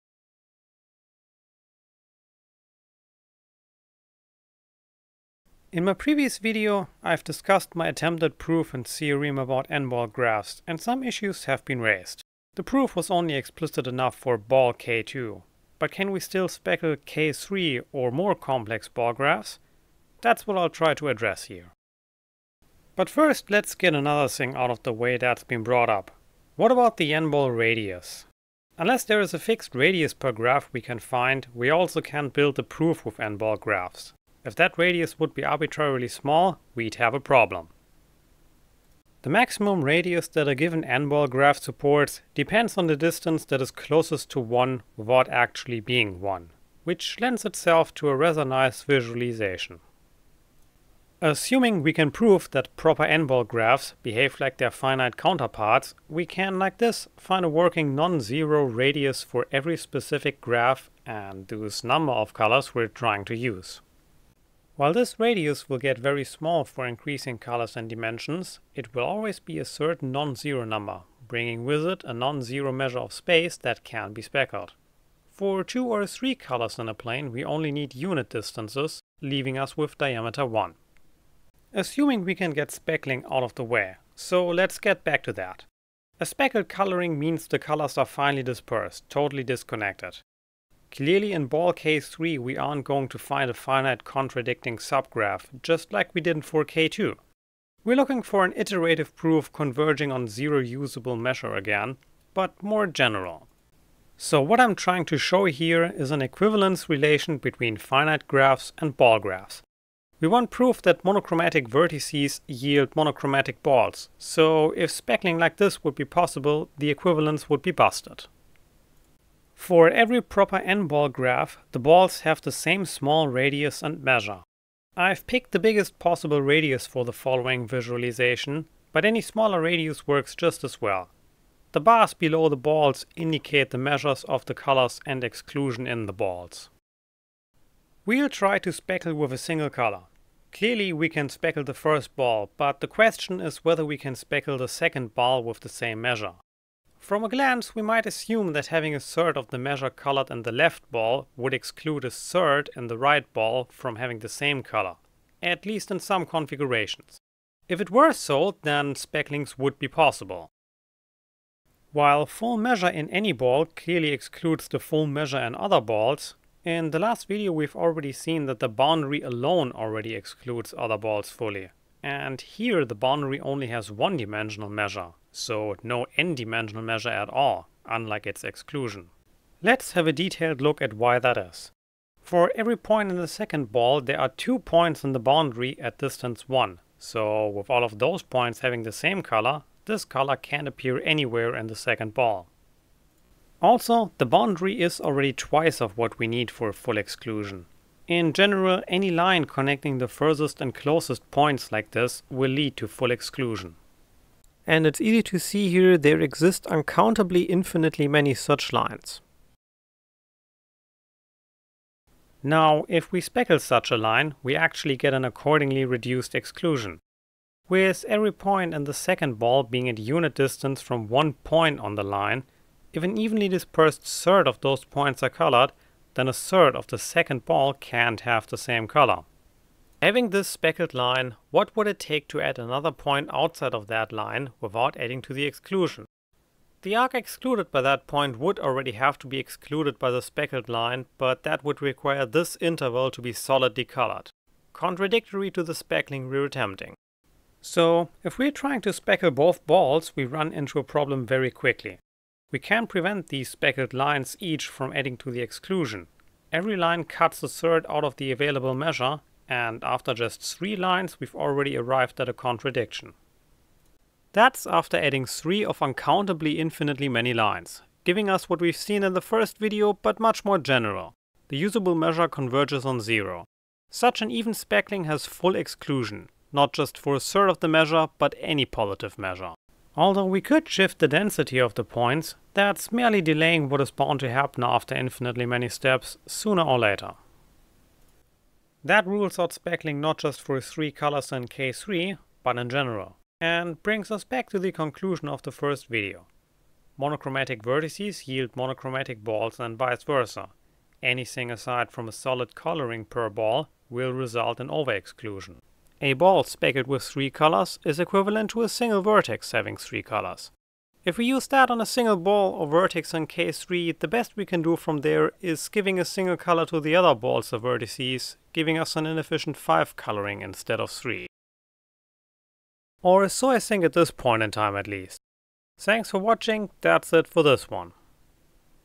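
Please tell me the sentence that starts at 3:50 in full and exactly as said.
Having this speckled line, what would it take to add another point outside of that line without adding to the exclusion?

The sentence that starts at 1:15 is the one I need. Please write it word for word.
For two or three colors in a plane we only need unit distances, leaving us with diameter 1.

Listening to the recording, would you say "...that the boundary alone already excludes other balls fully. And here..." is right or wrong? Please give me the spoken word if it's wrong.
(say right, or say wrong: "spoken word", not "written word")
right.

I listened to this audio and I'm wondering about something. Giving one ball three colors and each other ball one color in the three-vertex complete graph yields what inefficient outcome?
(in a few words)
5 coloring.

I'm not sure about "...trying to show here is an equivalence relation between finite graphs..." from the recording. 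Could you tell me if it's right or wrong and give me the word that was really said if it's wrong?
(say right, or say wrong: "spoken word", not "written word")
right.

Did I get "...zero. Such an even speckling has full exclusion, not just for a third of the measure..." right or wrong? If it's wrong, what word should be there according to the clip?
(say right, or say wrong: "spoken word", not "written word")
right.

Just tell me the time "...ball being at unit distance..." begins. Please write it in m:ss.
3:39.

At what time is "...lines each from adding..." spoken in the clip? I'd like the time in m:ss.
4:13.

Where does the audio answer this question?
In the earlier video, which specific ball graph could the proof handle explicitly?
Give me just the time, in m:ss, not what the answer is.
0:14.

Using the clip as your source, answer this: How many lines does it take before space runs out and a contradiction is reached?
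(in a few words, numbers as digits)
3.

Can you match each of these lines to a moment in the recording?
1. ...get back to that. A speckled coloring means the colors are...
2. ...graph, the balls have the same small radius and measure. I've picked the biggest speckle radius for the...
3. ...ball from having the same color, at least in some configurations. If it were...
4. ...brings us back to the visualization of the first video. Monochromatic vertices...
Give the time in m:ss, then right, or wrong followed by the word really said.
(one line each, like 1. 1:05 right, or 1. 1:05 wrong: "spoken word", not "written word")
1. 1:24 right
2. 2:01 wrong: "possible", not "speckle"
3. 2:33 right
4. 4:53 wrong: "conclusion", not "visualization".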